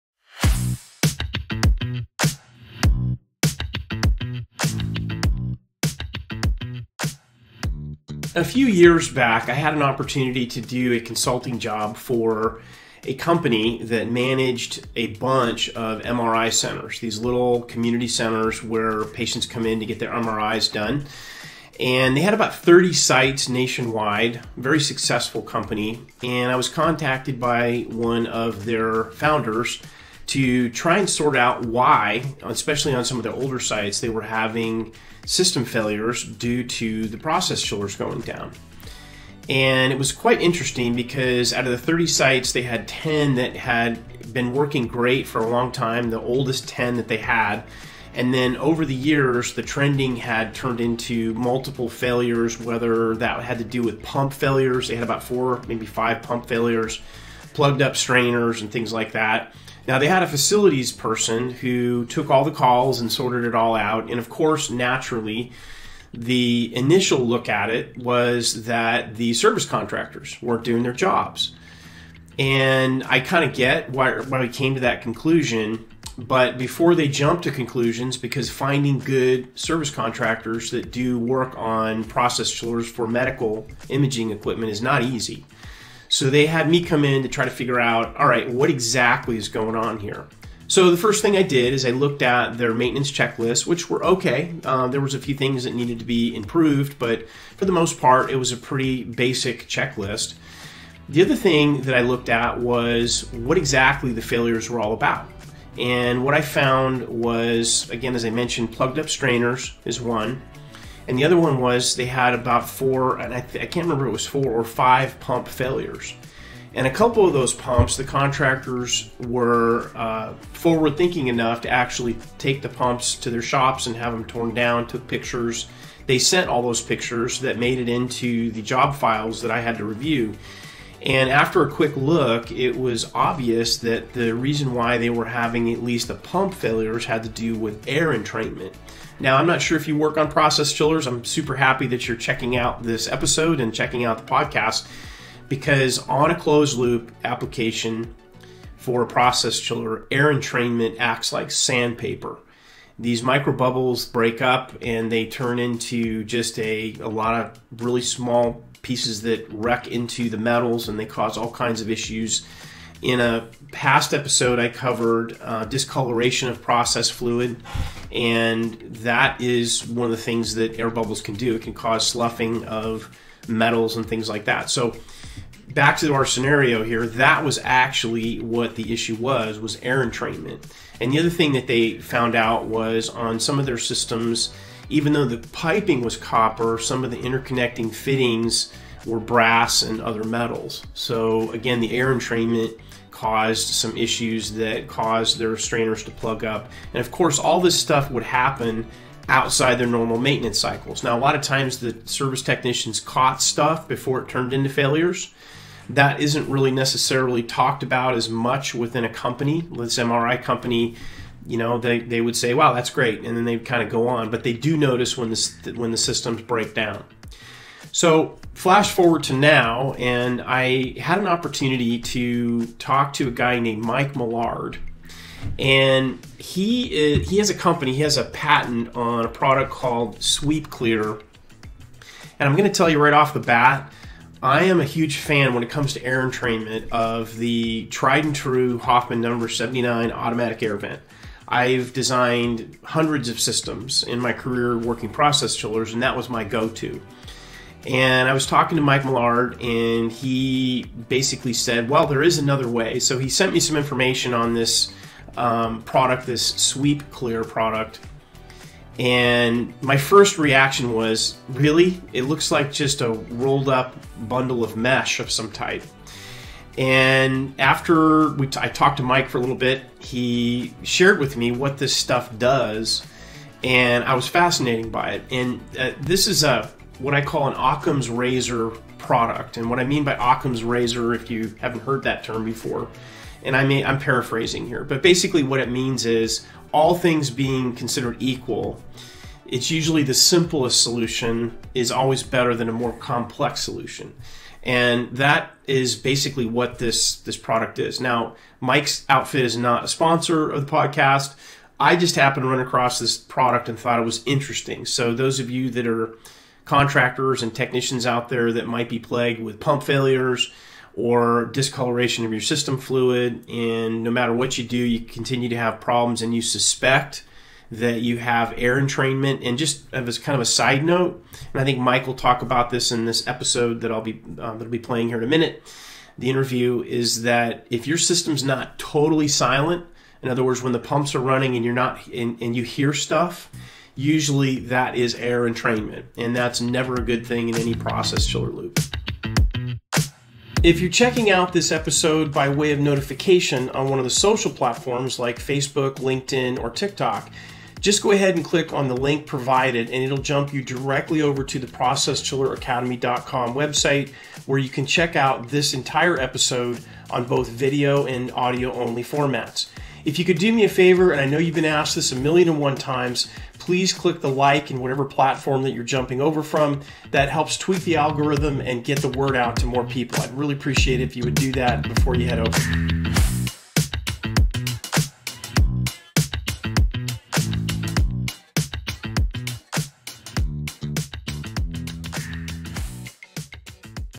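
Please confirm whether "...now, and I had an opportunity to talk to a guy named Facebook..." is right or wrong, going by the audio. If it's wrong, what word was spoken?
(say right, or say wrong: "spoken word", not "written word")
wrong: "Mike", not "Facebook".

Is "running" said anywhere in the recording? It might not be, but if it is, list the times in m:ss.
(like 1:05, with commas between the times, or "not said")
5:31.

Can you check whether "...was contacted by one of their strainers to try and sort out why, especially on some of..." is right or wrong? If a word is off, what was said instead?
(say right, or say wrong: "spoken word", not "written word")
wrong: "founders", not "strainers".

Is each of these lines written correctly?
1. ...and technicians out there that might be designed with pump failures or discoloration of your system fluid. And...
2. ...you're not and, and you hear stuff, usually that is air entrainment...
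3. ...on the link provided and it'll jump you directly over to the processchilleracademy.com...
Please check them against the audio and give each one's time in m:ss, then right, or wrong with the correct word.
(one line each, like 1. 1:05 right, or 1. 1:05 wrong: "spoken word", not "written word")
1. 5:07 wrong: "plagued", not "designed"
2. 5:31 right
3. 5:48 right.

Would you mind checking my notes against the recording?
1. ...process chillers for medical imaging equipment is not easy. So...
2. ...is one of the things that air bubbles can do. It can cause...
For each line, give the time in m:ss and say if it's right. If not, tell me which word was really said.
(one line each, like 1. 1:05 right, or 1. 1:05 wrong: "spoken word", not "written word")
1. 1:22 right
2. 2:49 right.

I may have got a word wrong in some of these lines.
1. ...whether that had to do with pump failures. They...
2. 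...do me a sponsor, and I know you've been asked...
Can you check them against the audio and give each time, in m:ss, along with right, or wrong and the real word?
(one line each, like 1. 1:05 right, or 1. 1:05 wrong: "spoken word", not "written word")
1. 0:52 right
2. 6:00 wrong: "favor", not "sponsor".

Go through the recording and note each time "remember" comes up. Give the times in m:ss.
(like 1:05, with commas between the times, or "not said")
1:53.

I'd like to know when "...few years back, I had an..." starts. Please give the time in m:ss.
0:08.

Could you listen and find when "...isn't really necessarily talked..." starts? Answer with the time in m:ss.
3:26.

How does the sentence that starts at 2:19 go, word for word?
Now, I'm not sure if you work on process chillers.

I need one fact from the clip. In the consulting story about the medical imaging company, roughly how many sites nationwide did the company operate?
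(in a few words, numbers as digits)
30.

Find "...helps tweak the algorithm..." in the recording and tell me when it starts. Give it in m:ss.
6:07.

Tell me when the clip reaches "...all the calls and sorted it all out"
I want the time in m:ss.
1:02.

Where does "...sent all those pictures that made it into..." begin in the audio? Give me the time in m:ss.
2:06.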